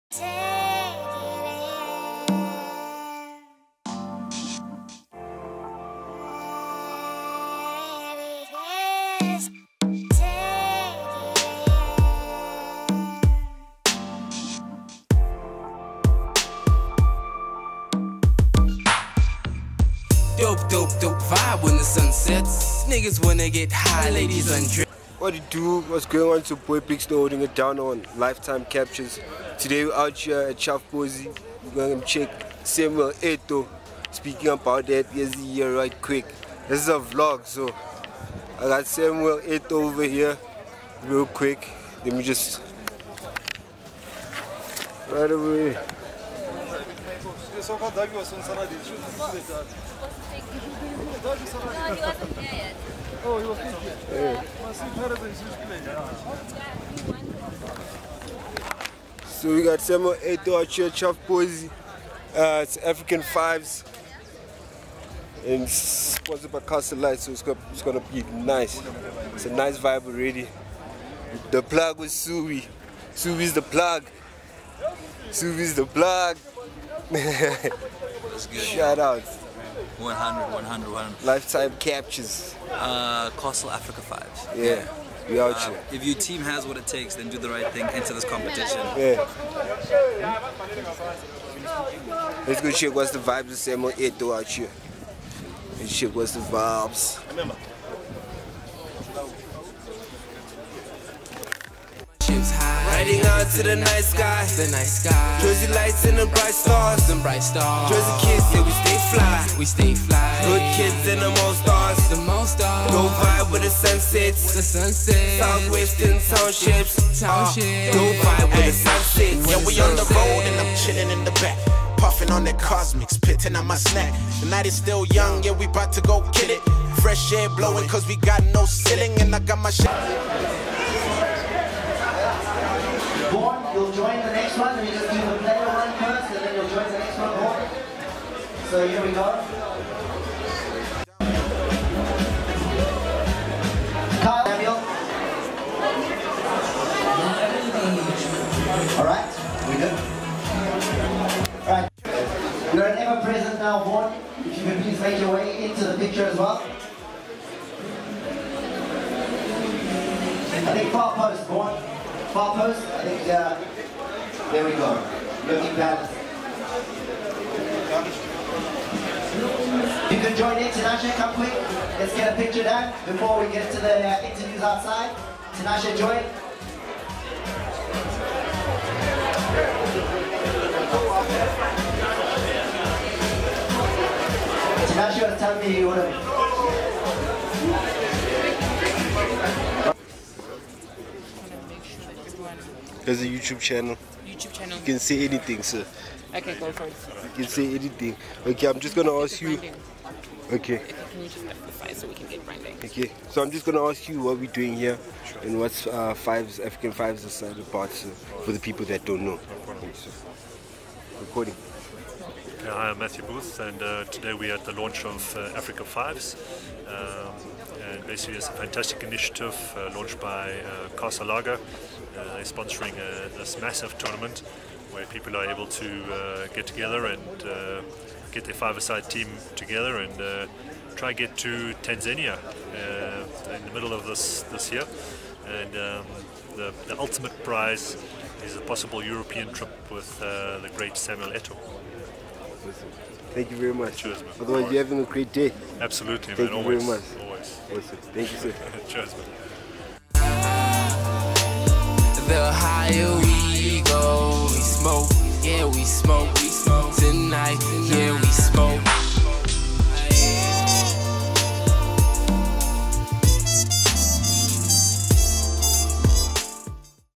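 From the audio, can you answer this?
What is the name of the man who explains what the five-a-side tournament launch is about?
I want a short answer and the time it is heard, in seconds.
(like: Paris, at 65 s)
Matthew Booth, at 212 s.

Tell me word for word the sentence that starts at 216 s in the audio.
Um, and basically, it's a fantastic initiative uh, launched by uh, Castle Lager.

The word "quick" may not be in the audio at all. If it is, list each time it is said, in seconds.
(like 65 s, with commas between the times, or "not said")
36 s, 41 s, 171 s.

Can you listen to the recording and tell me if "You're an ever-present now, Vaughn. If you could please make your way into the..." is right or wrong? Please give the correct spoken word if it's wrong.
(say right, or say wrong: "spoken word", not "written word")
right.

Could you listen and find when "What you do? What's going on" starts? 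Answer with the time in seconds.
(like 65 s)
25 s.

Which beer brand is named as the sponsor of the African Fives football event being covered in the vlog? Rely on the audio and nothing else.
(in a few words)
Castle Lite.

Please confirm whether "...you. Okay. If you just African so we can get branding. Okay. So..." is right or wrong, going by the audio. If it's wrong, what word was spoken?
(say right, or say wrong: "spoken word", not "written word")
wrong: "FFI", not "African".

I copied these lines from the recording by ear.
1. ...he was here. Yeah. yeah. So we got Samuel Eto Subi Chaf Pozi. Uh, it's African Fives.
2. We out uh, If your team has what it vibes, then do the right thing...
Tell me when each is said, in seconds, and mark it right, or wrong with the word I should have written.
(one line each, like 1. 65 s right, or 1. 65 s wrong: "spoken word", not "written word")
1. 53 s wrong: "Achia", not "Subi"
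2. 85 s wrong: "takes", not "vibes".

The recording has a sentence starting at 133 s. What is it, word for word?
Born, you'll join the next one, you do the one first, and then you'll join the next one, Born.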